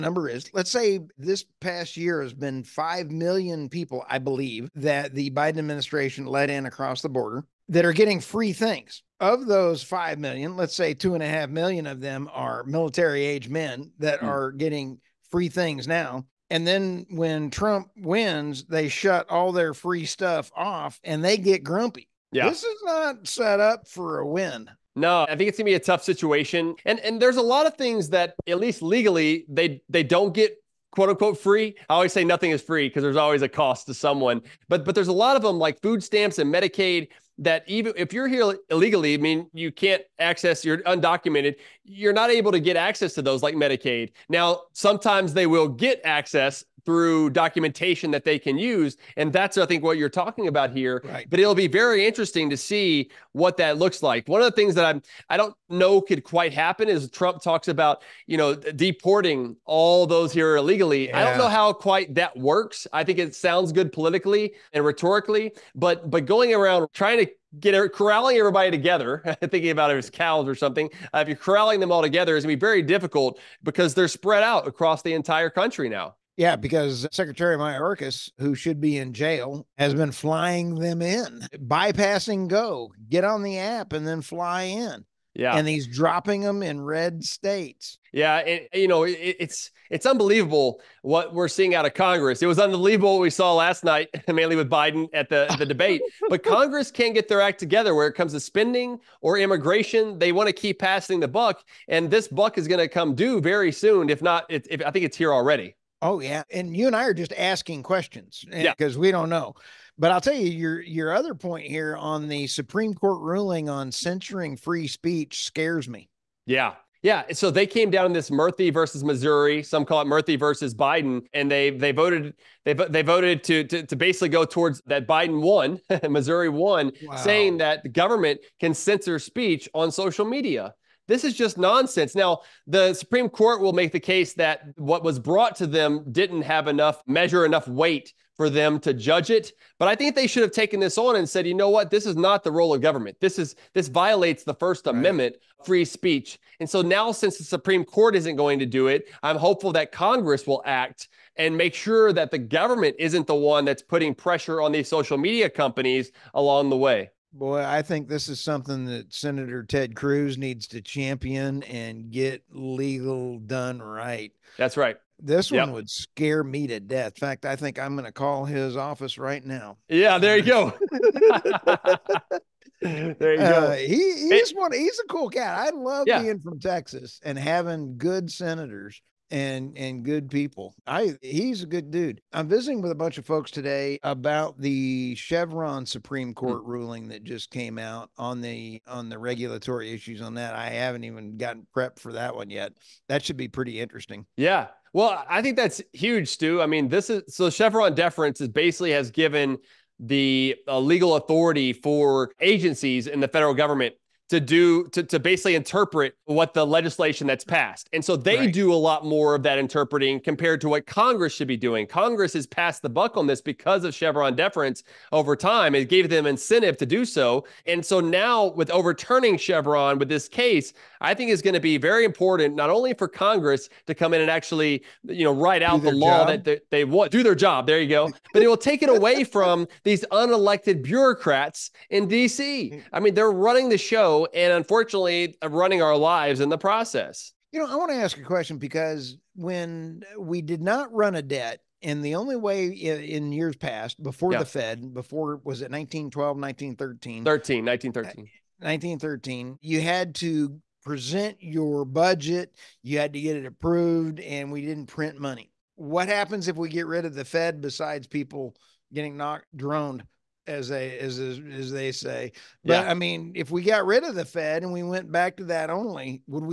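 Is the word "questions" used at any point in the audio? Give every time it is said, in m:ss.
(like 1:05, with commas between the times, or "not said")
1:47, 3:58.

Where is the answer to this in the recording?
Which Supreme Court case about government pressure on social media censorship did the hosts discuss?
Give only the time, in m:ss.
1:58.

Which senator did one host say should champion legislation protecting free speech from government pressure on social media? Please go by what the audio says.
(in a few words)
Ted Cruz.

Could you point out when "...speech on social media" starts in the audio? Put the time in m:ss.
2:09.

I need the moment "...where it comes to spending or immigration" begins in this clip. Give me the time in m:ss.
1:37.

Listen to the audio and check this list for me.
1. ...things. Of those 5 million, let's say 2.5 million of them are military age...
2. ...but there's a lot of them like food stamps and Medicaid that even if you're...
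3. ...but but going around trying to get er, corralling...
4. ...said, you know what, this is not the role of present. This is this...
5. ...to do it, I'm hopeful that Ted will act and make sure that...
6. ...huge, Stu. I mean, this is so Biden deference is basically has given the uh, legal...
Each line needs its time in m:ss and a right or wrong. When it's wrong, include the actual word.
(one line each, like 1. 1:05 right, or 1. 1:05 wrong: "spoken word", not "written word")
1. 0:08 right
2. 0:34 right
3. 1:05 right
4. 2:21 wrong: "government", not "present"
5. 2:28 wrong: "Congress", not "Ted"
6. 3:15 wrong: "Chevron", not "Biden".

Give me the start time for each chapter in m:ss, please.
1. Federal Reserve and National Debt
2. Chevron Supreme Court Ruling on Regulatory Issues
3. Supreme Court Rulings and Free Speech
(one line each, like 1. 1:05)
1. 3:58
2. 3:14
3. 1:57.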